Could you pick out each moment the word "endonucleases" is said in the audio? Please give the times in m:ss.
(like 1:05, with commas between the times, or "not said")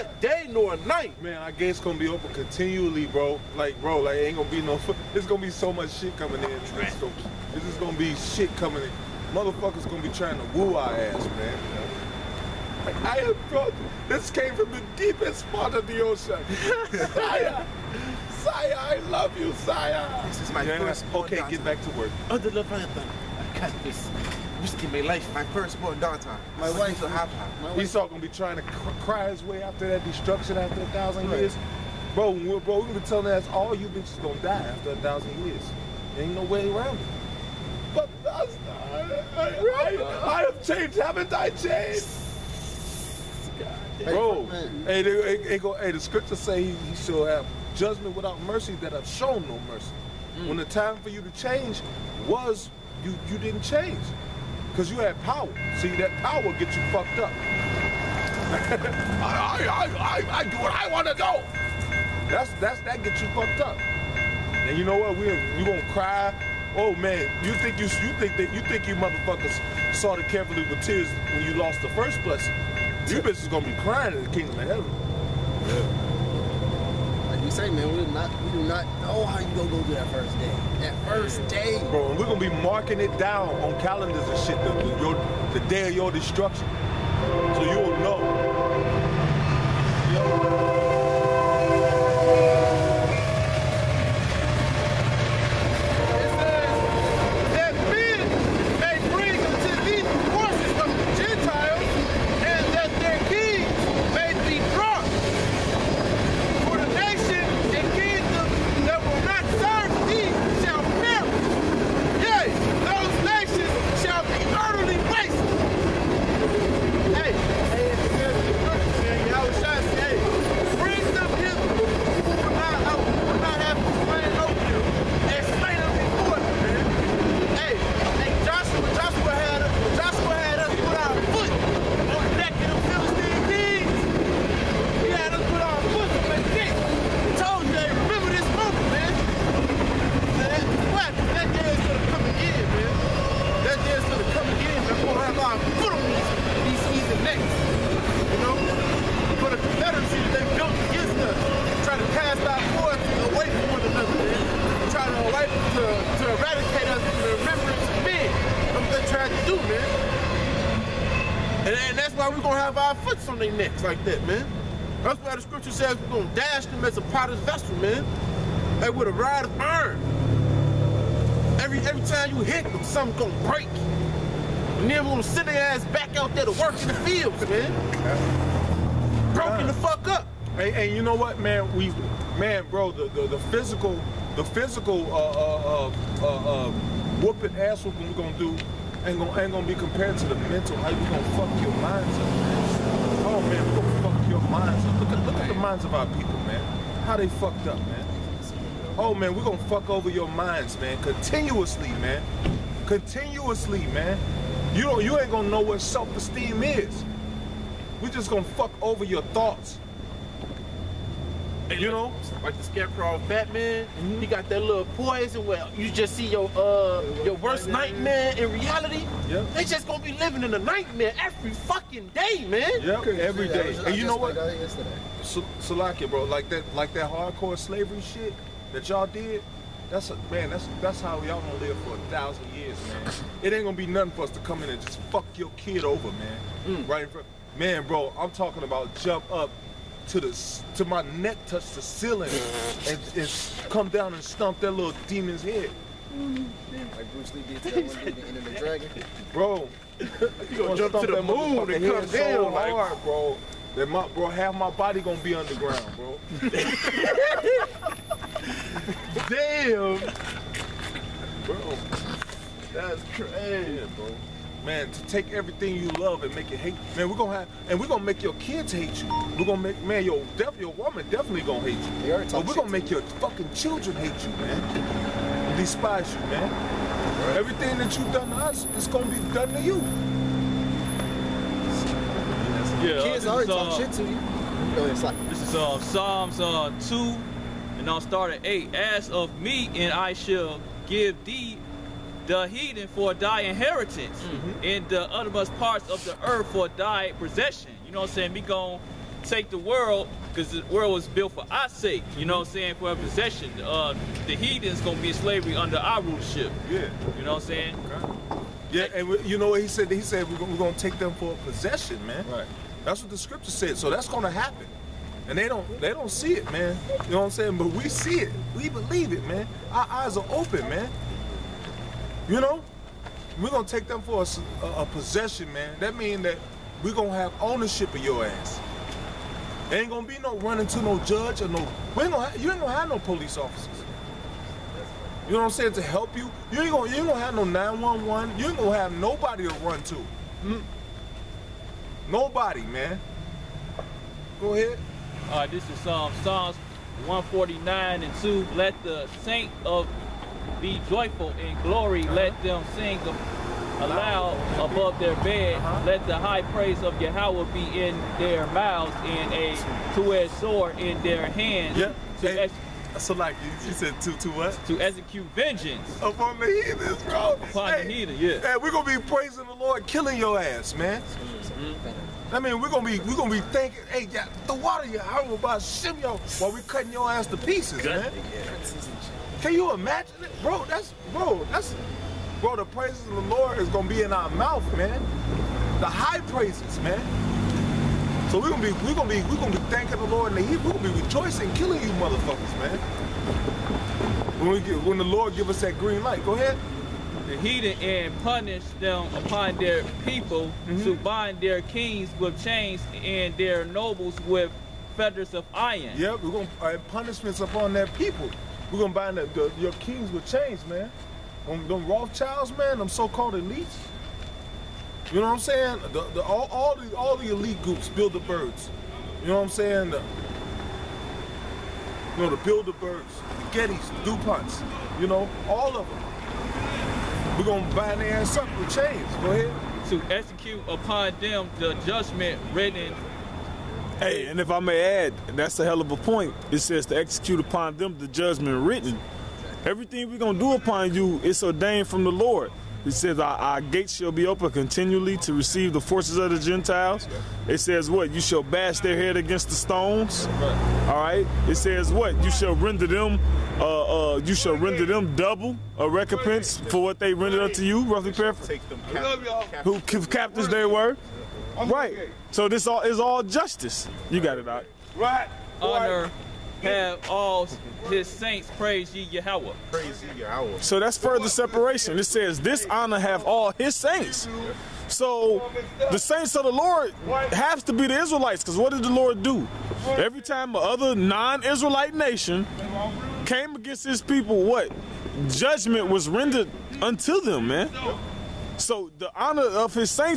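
not said.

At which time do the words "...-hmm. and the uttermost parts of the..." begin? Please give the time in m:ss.
4:54.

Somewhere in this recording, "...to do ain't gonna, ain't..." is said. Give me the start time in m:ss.
3:08.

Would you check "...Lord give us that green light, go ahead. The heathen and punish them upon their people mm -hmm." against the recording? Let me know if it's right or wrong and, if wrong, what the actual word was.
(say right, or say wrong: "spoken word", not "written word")
right.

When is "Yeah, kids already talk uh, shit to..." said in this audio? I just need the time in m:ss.
4:42.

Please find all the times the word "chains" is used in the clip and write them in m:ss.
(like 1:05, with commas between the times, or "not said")
6:42, 6:50, 7:08.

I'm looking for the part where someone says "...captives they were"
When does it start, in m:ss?
7:39.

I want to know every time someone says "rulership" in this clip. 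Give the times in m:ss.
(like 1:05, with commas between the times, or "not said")
5:06.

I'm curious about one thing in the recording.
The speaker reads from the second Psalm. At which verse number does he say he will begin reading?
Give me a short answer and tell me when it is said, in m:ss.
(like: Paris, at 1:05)
8, at 4:48.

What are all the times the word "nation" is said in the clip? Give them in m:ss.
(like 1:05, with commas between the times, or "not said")
8:01.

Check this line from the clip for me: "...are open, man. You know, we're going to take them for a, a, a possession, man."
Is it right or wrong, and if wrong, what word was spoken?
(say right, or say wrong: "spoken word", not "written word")
right.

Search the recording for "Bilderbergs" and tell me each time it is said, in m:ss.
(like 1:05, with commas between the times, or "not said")
7:02.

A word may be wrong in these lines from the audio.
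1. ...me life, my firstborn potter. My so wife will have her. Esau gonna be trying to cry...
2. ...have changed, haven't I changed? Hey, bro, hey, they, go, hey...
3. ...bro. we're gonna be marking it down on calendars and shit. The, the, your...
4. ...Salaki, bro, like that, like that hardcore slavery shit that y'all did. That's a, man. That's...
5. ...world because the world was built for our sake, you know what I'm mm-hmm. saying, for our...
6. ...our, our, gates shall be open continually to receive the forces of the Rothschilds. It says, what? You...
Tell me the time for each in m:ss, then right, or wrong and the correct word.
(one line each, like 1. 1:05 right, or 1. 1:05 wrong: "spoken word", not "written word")
1. 0:24 wrong: "daughter", not "potter"
2. 0:40 right
3. 1:21 right
4. 3:45 right
5. 4:59 right
6. 7:23 wrong: "Gentiles", not "Rothschilds".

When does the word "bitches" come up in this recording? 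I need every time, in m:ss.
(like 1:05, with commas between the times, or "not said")
0:33, 1:13.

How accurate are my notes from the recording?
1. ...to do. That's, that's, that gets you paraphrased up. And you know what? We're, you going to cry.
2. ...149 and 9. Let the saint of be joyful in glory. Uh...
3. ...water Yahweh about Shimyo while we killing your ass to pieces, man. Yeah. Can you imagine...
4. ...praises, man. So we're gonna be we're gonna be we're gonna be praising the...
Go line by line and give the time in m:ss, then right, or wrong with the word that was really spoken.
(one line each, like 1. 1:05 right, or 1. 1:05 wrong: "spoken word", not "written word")
1. 1:01 wrong: "fucked", not "paraphrased"
2. 5:47 wrong: "2", not "9"
3. 6:14 wrong: "cutting", not "killing"
4. 6:26 wrong: "thanking", not "praising".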